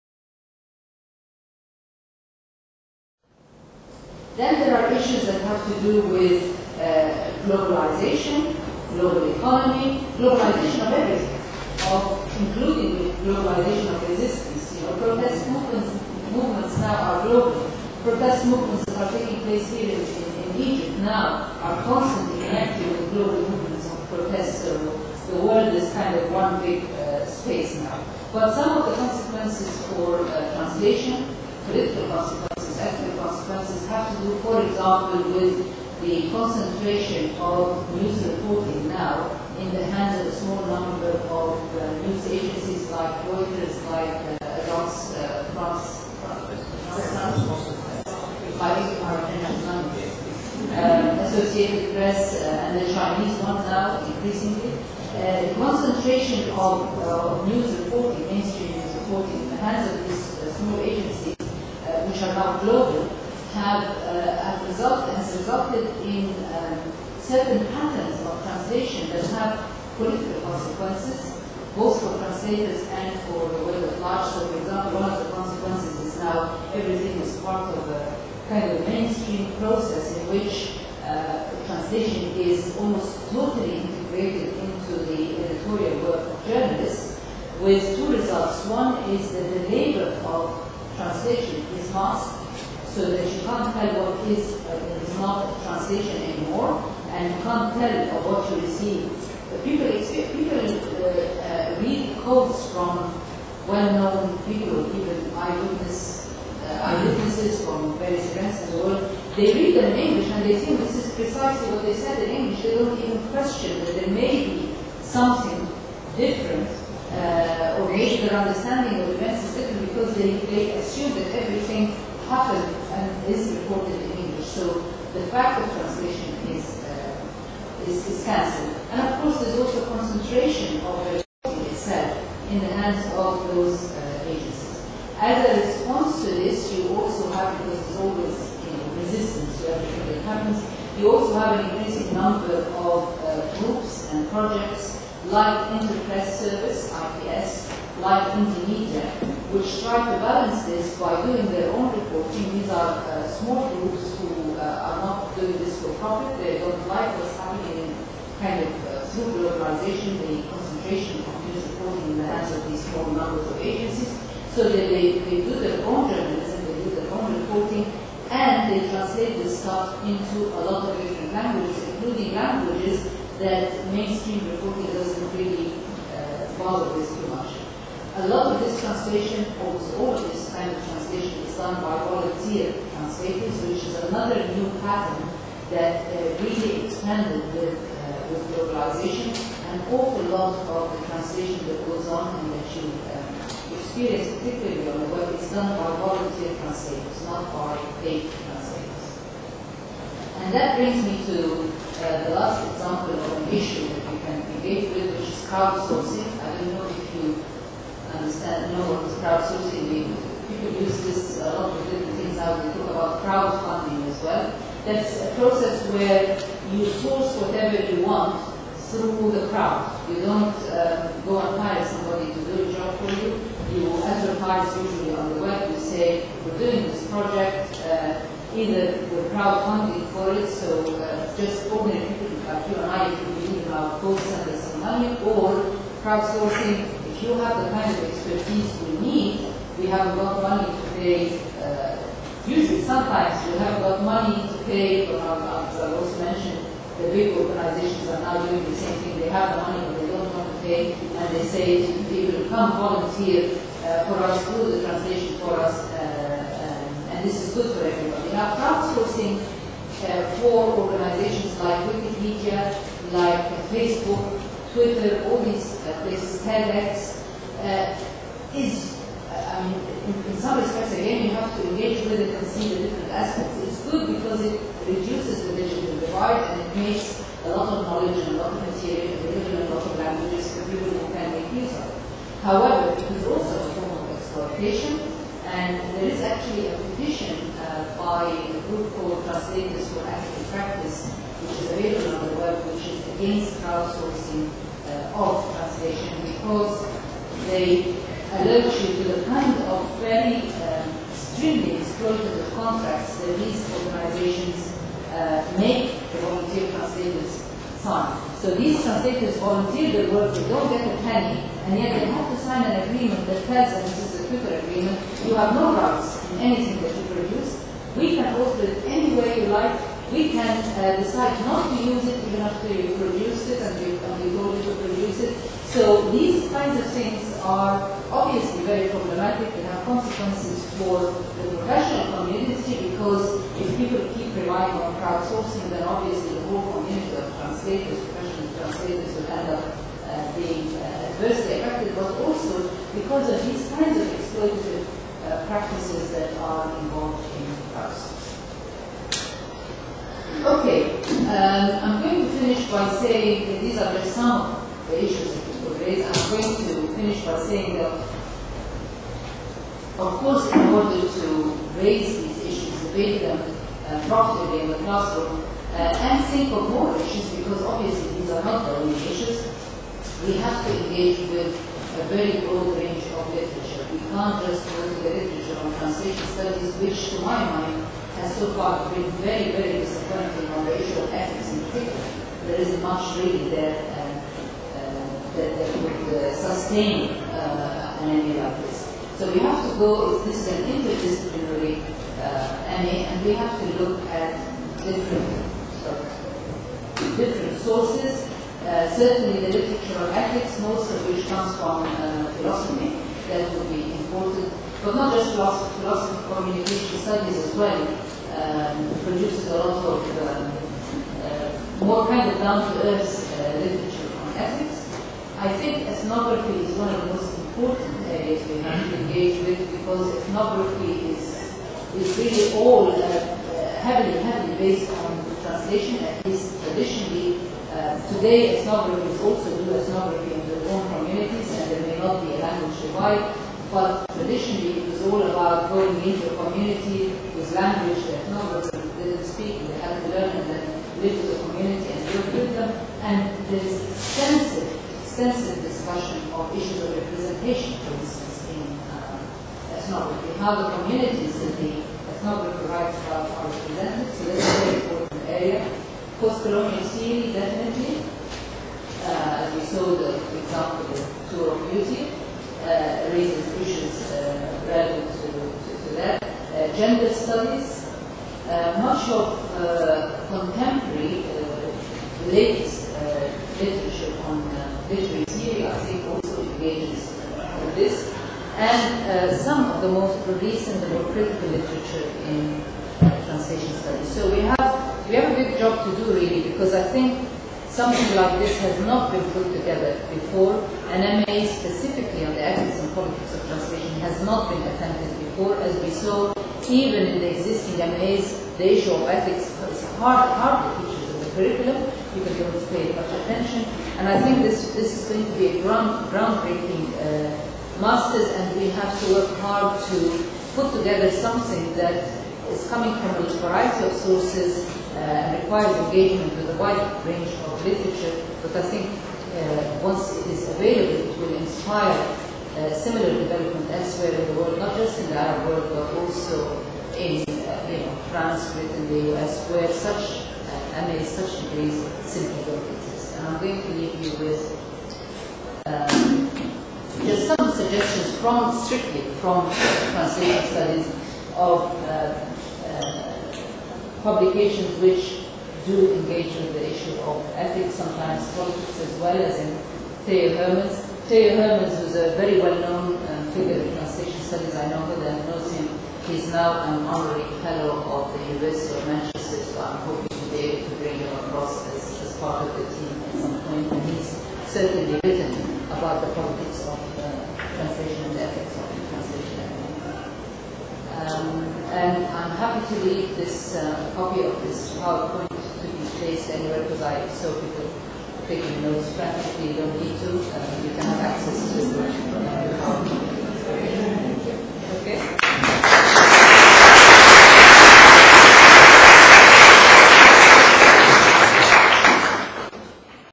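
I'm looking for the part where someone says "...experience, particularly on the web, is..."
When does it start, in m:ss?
3:13.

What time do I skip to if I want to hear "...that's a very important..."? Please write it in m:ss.
7:34.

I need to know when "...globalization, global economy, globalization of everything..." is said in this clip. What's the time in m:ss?
0:07.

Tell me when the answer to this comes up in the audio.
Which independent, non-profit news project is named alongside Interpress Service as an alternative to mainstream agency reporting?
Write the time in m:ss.
2:28.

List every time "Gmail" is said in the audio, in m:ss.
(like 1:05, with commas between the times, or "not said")
not said.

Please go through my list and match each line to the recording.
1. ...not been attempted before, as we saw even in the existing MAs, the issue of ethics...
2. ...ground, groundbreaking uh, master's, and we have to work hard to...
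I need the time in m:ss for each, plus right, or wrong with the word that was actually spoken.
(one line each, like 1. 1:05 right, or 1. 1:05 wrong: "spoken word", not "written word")
1. 8:14 right
2. 8:25 right.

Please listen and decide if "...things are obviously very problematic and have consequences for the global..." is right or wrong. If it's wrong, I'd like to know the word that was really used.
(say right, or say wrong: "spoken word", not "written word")
wrong: "professional", not "global".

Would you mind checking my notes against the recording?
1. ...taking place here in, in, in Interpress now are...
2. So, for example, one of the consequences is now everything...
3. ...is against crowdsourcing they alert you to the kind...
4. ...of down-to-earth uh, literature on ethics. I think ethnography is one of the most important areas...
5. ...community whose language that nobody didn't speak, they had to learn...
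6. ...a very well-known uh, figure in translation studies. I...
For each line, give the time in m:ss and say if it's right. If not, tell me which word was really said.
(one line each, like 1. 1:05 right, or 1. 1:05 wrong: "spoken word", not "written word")
1. 0:19 wrong: "Egypt", not "Interpress"
2. 1:14 right
3. 4:52 right
4. 6:52 right
5. 7:16 right
6. 9:11 right.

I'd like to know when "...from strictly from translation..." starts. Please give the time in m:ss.
8:58.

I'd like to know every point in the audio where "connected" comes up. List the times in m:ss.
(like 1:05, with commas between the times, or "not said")
0:22.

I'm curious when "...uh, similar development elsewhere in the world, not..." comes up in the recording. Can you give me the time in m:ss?
8:42.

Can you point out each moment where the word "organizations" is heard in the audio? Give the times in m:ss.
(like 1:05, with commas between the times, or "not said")
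4:07, 4:20, 5:03.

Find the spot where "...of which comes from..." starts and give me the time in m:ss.
6:40.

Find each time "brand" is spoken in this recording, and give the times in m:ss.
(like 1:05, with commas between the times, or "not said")
not said.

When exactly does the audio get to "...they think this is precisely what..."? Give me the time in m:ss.
1:50.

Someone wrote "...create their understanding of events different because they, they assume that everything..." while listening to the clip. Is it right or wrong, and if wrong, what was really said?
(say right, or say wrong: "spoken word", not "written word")
right.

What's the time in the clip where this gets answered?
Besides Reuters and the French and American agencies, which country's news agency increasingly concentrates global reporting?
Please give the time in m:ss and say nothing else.
0:52.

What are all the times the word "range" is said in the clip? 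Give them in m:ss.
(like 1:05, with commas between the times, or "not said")
6:12, 8:37.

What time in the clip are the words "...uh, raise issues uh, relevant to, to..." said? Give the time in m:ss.
7:42.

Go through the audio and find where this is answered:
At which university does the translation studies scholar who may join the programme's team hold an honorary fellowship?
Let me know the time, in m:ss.
9:18.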